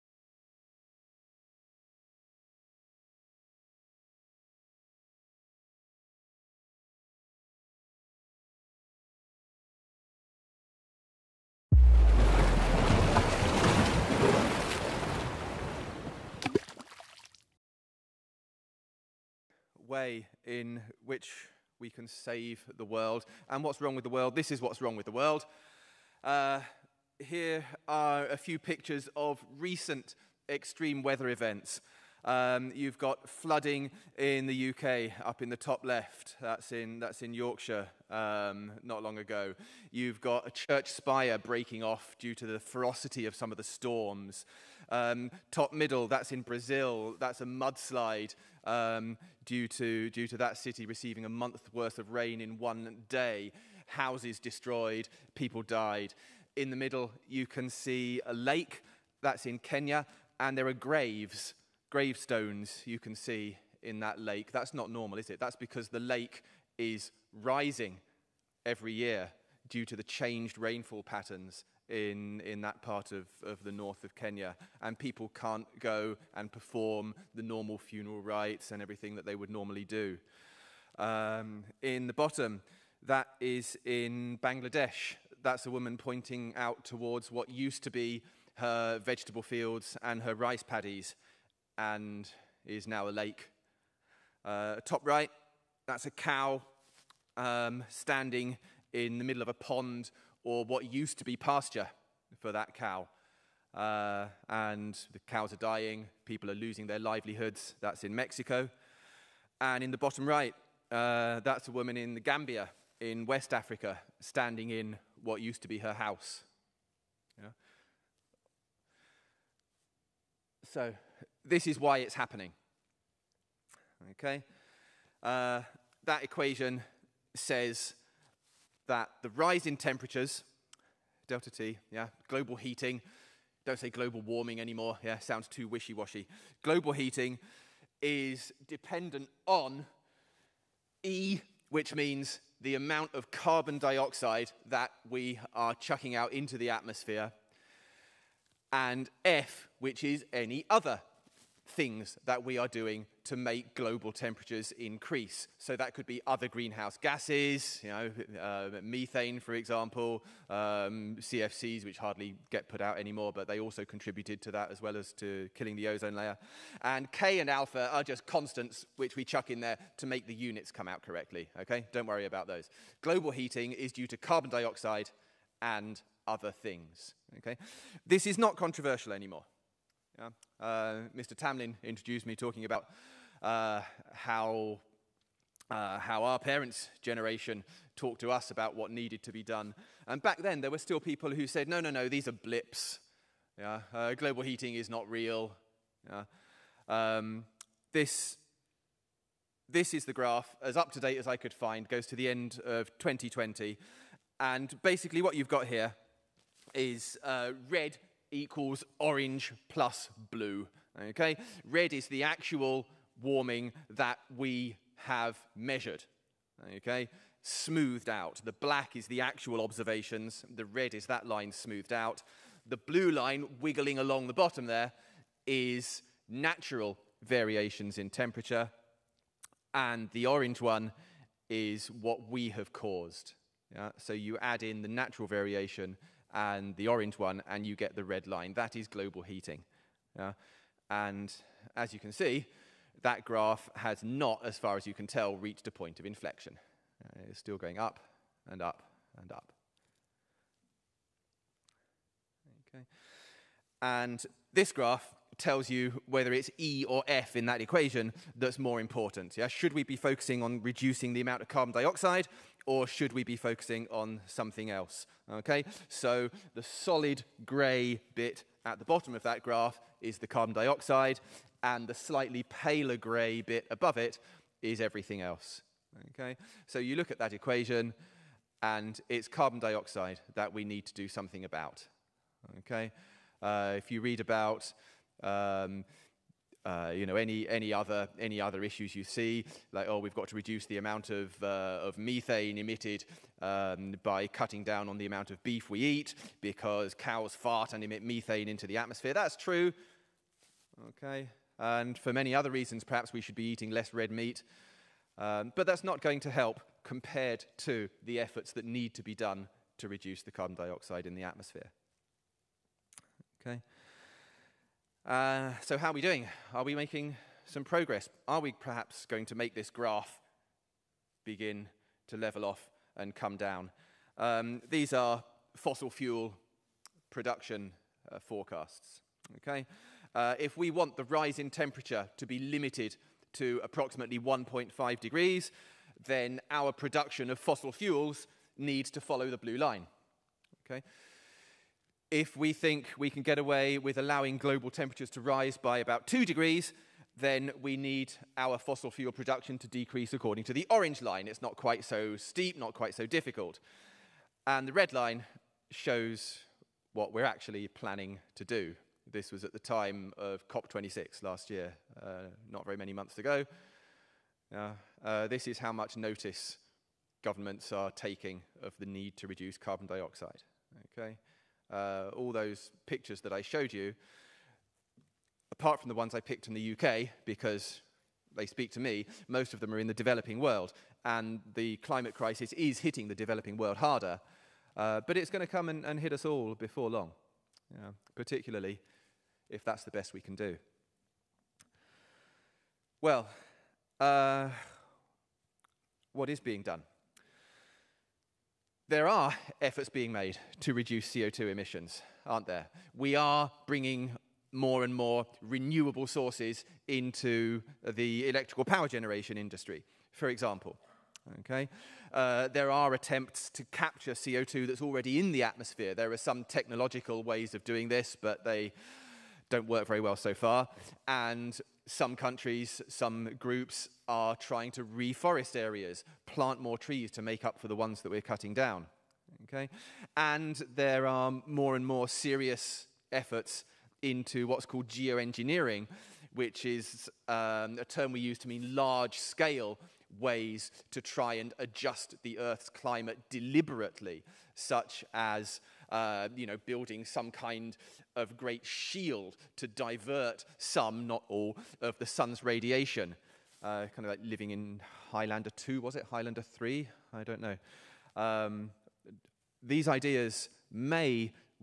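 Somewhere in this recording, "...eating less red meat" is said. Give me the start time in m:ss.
5:03.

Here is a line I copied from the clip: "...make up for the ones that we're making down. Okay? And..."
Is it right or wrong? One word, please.
wrong.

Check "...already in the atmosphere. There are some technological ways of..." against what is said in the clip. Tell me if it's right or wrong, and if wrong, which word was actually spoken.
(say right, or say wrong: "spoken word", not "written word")
right.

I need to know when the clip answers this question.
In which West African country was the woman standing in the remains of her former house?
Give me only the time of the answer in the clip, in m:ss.
1:52.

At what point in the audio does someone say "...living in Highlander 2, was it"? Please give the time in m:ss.
7:34.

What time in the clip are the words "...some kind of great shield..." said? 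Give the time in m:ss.
7:27.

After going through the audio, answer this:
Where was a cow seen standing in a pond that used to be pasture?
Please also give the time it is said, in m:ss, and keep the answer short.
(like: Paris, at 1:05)
Mexico, at 1:48.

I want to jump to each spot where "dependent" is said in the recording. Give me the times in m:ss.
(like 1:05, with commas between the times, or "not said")
2:18.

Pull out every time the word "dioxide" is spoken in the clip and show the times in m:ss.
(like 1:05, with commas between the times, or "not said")
2:23, 2:54, 4:21, 4:30, 4:39, 5:10, 6:09.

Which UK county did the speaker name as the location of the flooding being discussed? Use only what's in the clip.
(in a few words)
Yorkshire.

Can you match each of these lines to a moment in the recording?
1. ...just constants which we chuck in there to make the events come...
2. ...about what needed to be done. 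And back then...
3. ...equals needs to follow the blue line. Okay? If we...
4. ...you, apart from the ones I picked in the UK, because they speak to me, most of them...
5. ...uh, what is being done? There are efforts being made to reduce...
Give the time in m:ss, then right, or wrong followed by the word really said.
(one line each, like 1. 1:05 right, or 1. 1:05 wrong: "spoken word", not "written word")
1. 2:48 wrong: "units", not "events"
2. 3:08 right
3. 5:37 wrong: "fuels", not "equals"
4. 6:13 right
5. 6:33 right.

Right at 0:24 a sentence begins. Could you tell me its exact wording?
This is what's wrong with the world.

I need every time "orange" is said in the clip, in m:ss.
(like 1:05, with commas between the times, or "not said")
3:28, 3:50, 3:56, 5:50.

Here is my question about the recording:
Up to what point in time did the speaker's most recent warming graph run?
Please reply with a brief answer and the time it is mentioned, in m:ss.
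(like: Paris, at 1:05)
end of 2020, at 3:22.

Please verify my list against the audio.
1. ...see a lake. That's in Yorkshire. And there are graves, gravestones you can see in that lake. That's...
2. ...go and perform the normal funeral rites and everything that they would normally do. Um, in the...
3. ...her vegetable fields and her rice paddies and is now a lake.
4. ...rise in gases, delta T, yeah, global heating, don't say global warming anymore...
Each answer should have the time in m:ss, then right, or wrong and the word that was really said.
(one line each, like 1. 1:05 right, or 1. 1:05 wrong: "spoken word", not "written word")
1. 0:57 wrong: "Kenya", not "Yorkshire"
2. 1:15 right
3. 1:28 right
4. 2:09 wrong: "temperatures", not "gases".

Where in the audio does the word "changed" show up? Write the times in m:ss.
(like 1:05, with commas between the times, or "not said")
1:10.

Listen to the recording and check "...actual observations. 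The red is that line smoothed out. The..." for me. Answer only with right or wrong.
right.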